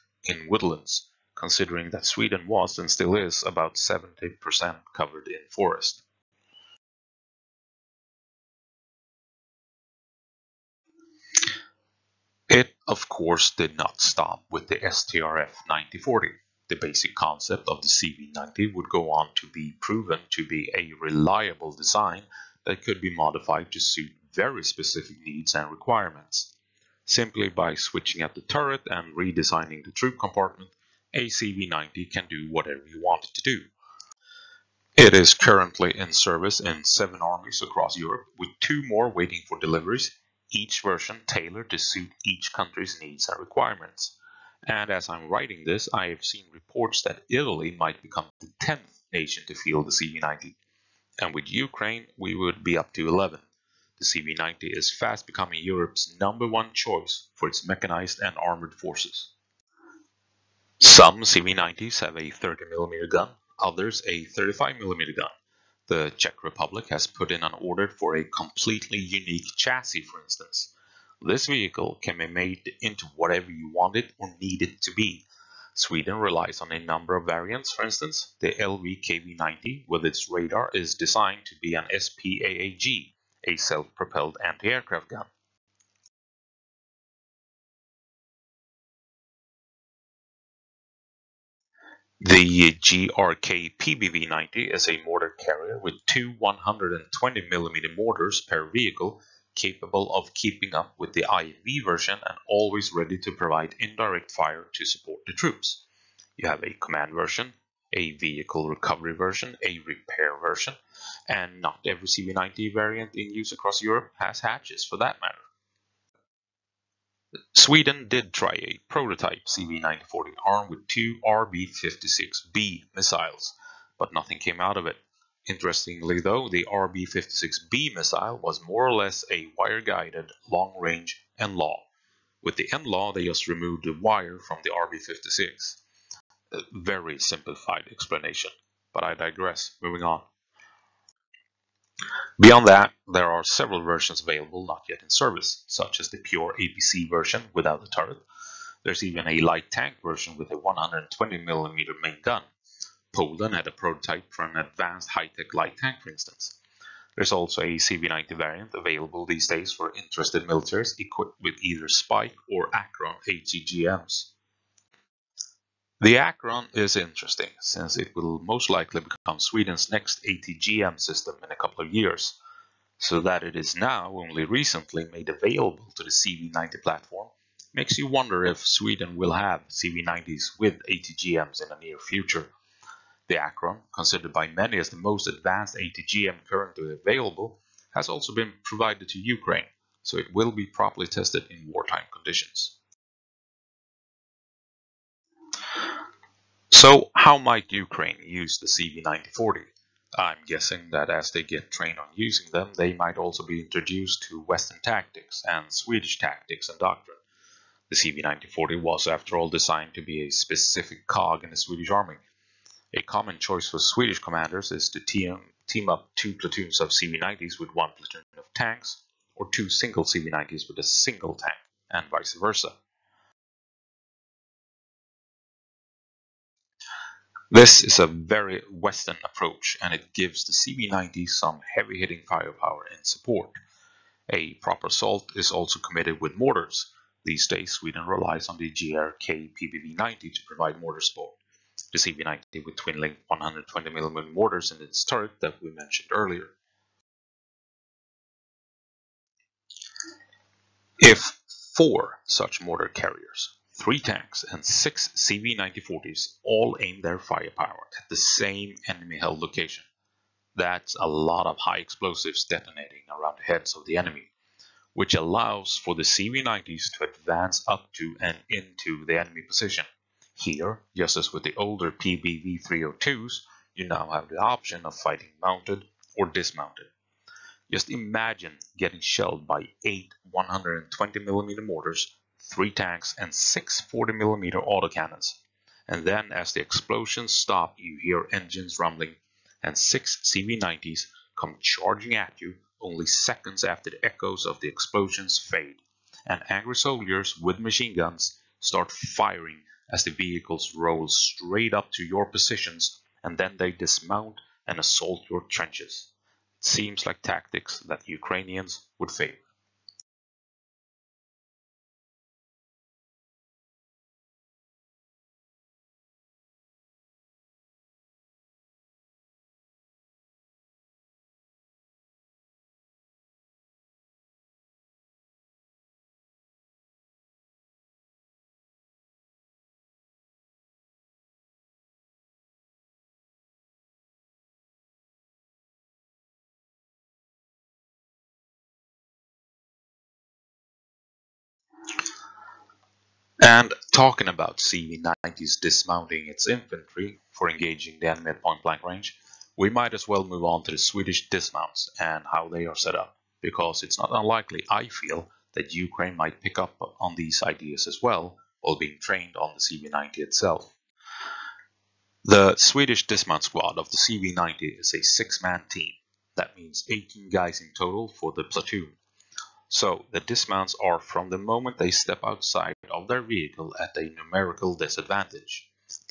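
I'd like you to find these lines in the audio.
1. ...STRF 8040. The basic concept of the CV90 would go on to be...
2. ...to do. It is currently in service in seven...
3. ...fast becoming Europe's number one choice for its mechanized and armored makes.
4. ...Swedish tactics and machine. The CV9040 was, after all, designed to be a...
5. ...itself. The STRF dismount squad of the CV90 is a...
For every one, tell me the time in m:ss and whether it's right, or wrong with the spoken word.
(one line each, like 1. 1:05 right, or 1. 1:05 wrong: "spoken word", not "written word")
1. 0:14 wrong: "9040", not "8040"
2. 0:33 right
3. 0:54 wrong: "forces", not "makes"
4. 3:25 wrong: "doctrine", not "machine"
5. 6:00 wrong: "Swedish", not "STRF".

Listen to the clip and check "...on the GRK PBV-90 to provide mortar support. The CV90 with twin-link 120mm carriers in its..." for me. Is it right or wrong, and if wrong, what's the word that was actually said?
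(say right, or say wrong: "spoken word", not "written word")
wrong: "mortars", not "carriers".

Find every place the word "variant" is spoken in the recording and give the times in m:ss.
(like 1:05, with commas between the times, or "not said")
1:17, 1:52, 2:38.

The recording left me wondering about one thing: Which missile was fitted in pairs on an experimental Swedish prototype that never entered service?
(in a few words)
RB56B.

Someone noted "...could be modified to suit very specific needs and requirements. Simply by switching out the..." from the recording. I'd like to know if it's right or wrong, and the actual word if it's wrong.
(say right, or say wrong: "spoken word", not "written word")
right.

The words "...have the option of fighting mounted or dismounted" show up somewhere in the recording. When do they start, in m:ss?
4:34.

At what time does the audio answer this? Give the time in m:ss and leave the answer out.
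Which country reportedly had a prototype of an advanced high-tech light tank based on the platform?
2:33.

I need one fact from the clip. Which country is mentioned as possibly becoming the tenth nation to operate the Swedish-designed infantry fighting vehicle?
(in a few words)
Italy.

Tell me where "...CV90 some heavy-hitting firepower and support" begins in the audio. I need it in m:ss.
3:50.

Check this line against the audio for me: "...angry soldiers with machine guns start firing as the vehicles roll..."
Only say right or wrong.
right.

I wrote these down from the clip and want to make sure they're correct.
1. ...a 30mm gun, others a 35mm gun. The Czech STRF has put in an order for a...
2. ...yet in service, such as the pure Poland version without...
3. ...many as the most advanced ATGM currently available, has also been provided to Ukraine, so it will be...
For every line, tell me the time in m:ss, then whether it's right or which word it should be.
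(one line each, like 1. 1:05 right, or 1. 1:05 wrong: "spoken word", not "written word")
1. 1:02 wrong: "Republic", not "STRF"
2. 2:24 wrong: "APC", not "Poland"
3. 3:04 right.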